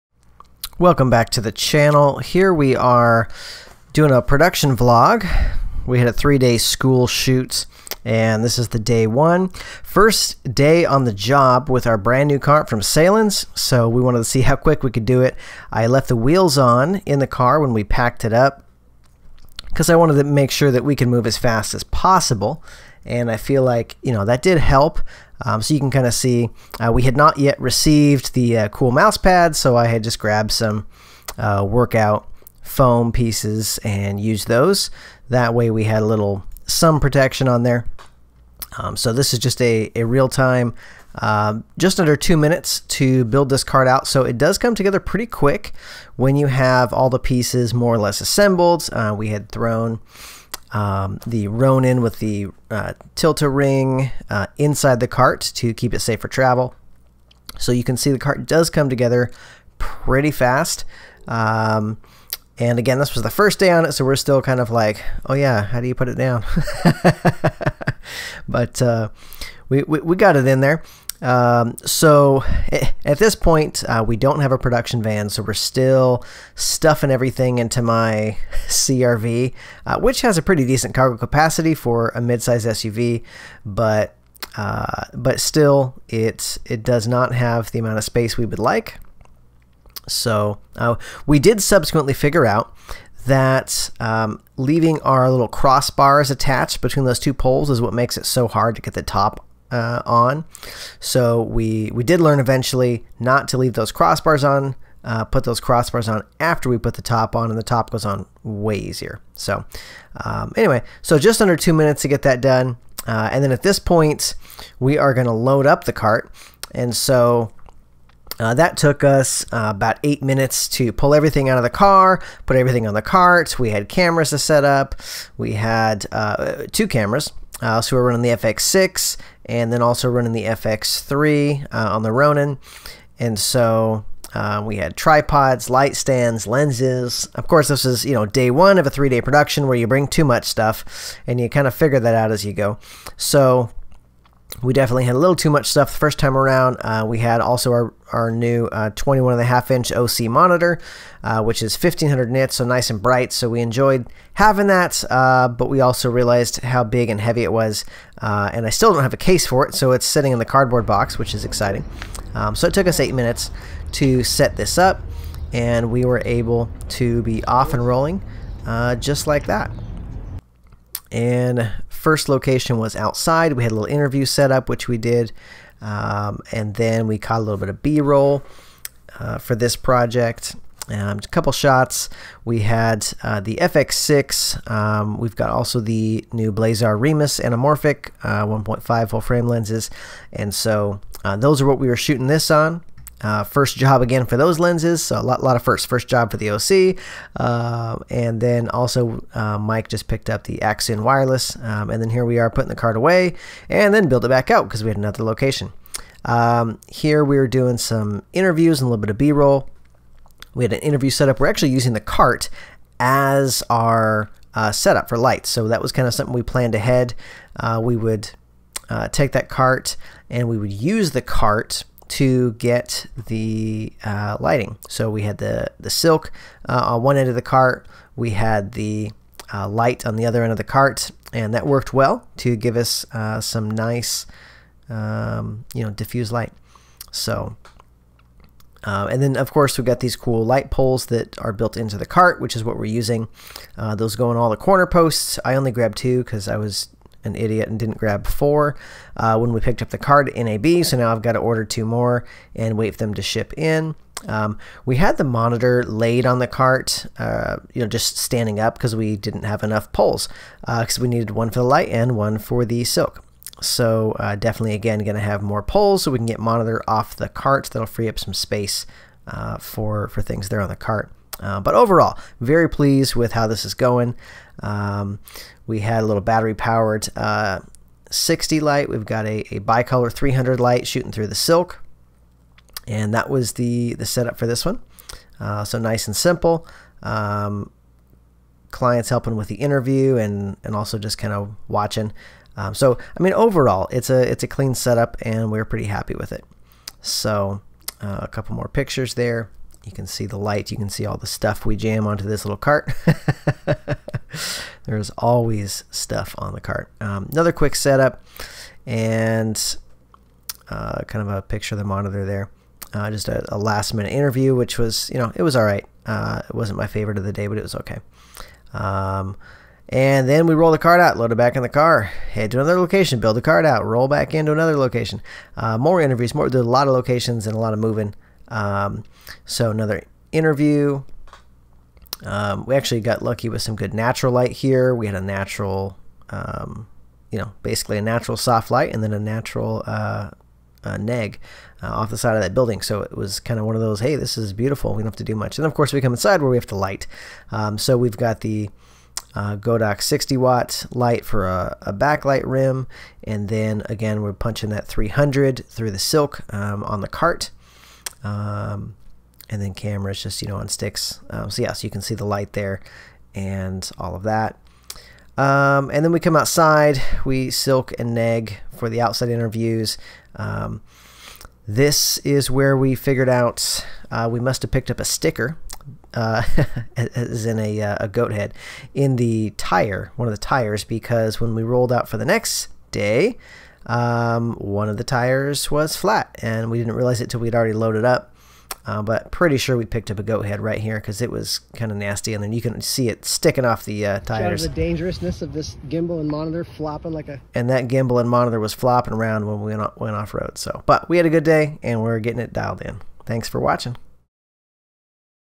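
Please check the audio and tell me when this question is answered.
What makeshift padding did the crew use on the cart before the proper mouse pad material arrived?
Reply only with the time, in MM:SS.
00:31.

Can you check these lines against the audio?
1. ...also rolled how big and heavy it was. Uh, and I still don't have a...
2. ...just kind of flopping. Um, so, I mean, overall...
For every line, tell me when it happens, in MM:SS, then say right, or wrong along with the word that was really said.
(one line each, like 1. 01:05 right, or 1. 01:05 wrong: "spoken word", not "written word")
1. 02:35 wrong: "realized", not "rolled"
2. 04:50 wrong: "watching", not "flopping".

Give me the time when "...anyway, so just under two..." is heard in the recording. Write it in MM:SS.
01:50.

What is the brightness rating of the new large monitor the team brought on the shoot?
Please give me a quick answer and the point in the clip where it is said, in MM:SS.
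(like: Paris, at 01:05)
1500 nits, at 02:31.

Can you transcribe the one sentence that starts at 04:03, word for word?
Uh, those go on all the corner posts.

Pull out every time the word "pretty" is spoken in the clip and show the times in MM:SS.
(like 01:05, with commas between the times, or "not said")
00:45, 00:59, 01:20, 04:55, 06:29.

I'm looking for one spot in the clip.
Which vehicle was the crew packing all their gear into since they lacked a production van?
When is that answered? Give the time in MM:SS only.
01:18.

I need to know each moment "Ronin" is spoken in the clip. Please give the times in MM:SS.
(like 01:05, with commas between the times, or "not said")
00:51, 02:12.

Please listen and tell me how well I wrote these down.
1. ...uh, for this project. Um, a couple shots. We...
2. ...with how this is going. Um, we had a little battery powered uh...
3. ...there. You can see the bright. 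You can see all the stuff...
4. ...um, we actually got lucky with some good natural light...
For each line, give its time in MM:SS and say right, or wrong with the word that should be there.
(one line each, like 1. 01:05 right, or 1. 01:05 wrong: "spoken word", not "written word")
1. 02:59 right
2. 04:33 right
3. 04:59 wrong: "light", not "bright"
4. 05:32 right.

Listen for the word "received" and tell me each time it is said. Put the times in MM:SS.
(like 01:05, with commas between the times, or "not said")
00:27.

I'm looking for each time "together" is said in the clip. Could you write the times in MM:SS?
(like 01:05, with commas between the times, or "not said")
00:44, 00:58.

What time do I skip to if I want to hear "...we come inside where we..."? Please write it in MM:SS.
05:45.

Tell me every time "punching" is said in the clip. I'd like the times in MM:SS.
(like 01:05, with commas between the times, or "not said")
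05:54.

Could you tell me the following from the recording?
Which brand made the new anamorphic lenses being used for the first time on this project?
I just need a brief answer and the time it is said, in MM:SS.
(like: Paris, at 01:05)
Blazar Remus, at 03:06.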